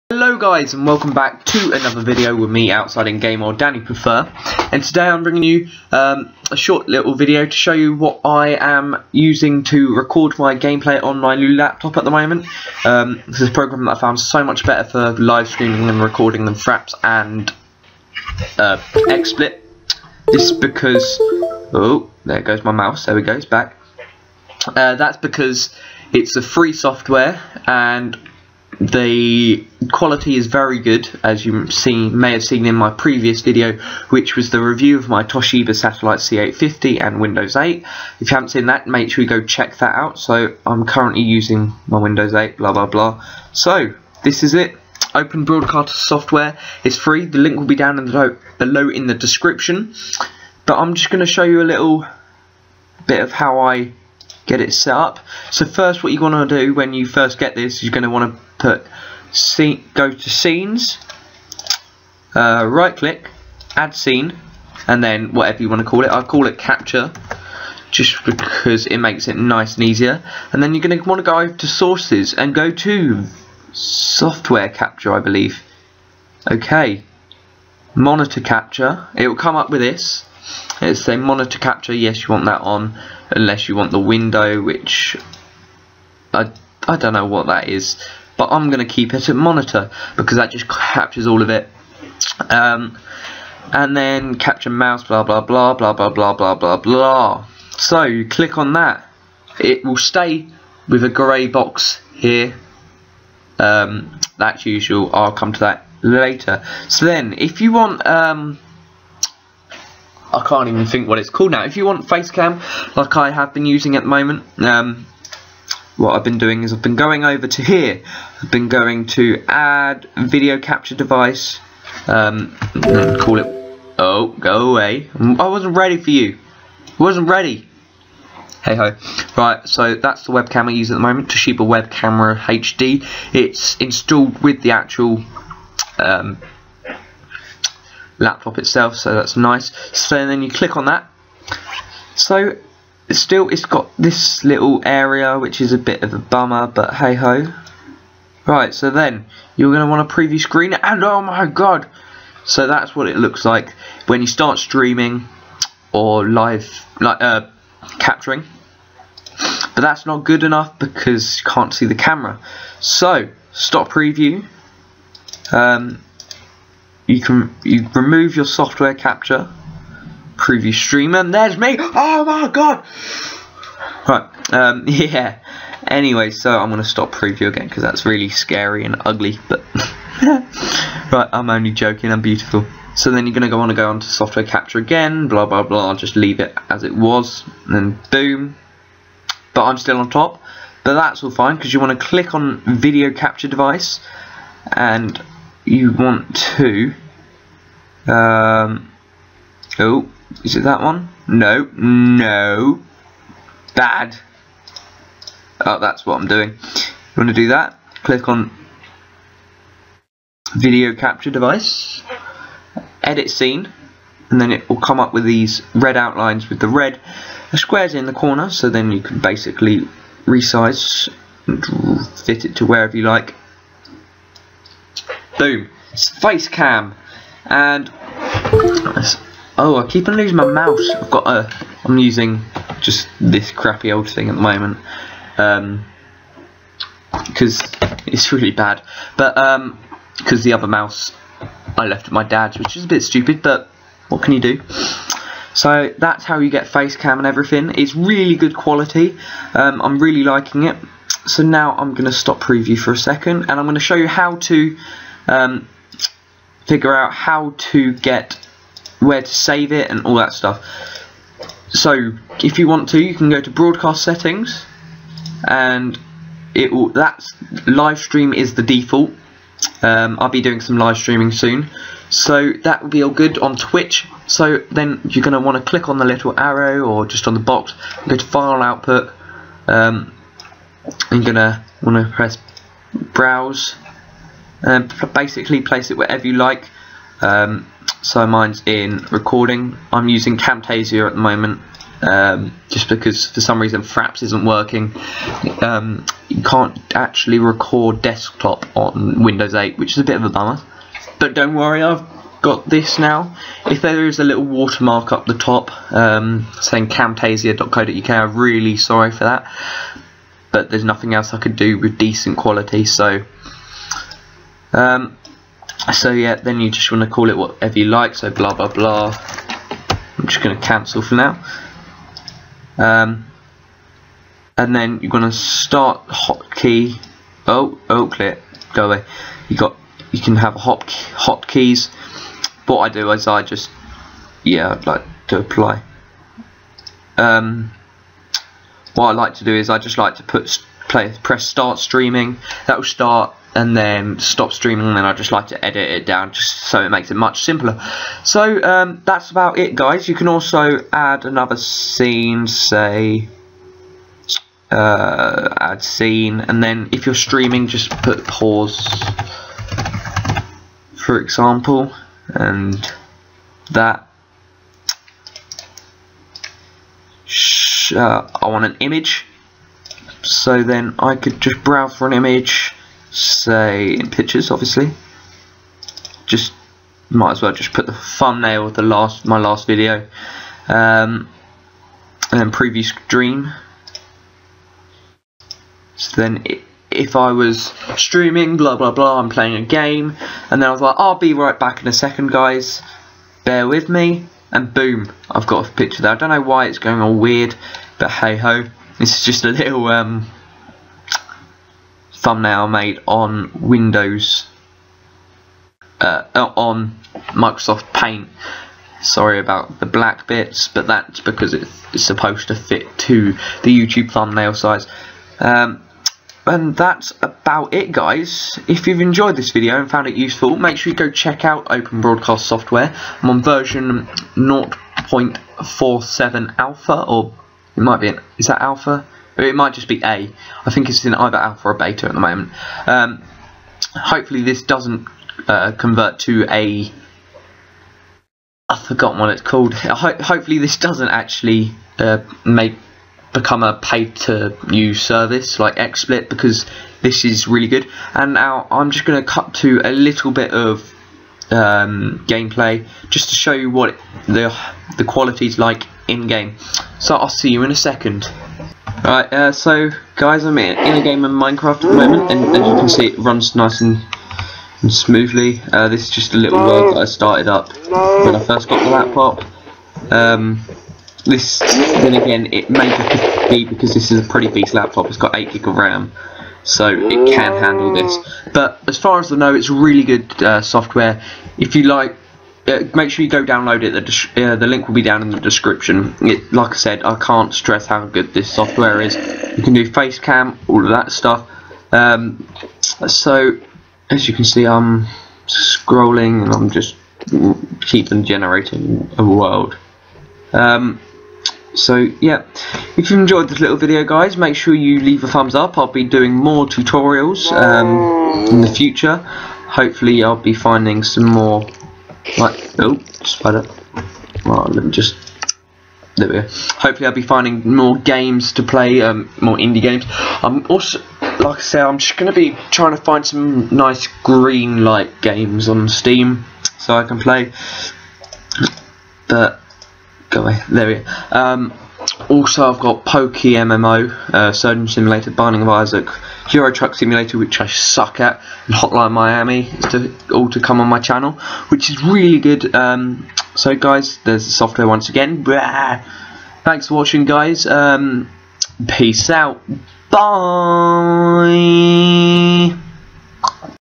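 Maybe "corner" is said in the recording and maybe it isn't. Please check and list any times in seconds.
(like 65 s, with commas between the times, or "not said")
218 s.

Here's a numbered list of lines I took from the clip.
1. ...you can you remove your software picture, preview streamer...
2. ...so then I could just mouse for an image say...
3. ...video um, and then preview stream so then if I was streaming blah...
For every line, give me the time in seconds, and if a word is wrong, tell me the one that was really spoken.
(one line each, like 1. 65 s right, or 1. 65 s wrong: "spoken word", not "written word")
1. 167 s wrong: "capture", not "picture"
2. 370 s wrong: "browse", not "mouse"
3. 379 s right.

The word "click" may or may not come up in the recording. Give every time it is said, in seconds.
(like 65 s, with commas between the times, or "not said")
62 s, 98 s, 140 s, 192 s, 208 s, 275 s.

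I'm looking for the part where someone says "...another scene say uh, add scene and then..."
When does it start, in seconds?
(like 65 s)
351 s.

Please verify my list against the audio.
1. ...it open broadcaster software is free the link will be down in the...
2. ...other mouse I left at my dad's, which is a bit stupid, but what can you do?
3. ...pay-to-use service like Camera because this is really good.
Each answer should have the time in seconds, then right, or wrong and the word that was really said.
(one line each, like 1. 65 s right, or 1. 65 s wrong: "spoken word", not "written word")
1. 44 s right
2. 240 s right
3. 443 s wrong: "XSplit", not "Camera".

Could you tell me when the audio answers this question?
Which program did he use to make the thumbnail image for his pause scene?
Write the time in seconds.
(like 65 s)
407 s.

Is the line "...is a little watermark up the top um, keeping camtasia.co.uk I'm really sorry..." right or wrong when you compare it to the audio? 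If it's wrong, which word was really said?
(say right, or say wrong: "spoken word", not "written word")
wrong: "saying", not "keeping".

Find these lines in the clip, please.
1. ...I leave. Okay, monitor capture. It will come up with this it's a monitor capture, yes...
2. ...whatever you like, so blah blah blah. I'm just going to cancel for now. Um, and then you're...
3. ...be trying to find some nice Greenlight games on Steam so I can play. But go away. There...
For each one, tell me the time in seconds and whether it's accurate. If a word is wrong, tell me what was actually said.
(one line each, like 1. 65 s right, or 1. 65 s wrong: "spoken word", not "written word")
1. 75 s wrong: "believe", not "leave"
2. 317 s right
3. 522 s right.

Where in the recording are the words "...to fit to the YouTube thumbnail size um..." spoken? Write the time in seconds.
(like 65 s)
412 s.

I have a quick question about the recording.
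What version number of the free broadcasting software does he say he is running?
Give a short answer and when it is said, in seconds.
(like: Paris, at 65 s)
0.47, at 424 s.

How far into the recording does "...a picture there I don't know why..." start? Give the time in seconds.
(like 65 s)
395 s.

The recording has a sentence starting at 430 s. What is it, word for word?
I think it's in either alpha or beta at the moment.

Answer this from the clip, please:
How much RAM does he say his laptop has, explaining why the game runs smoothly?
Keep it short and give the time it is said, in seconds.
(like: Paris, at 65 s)
8 GB, at 475 s.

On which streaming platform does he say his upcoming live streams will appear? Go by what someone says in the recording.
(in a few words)
Twitch.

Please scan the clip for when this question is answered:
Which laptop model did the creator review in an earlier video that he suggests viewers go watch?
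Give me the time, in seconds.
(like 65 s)
35 s.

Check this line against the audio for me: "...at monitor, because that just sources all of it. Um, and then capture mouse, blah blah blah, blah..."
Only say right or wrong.
wrong.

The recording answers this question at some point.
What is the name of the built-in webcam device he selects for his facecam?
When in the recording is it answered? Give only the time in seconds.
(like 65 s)
131 s.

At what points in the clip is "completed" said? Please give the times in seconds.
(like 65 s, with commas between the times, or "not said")
not said.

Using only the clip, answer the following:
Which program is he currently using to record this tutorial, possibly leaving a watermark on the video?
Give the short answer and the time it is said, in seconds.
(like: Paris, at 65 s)
Camtasia, at 290 s.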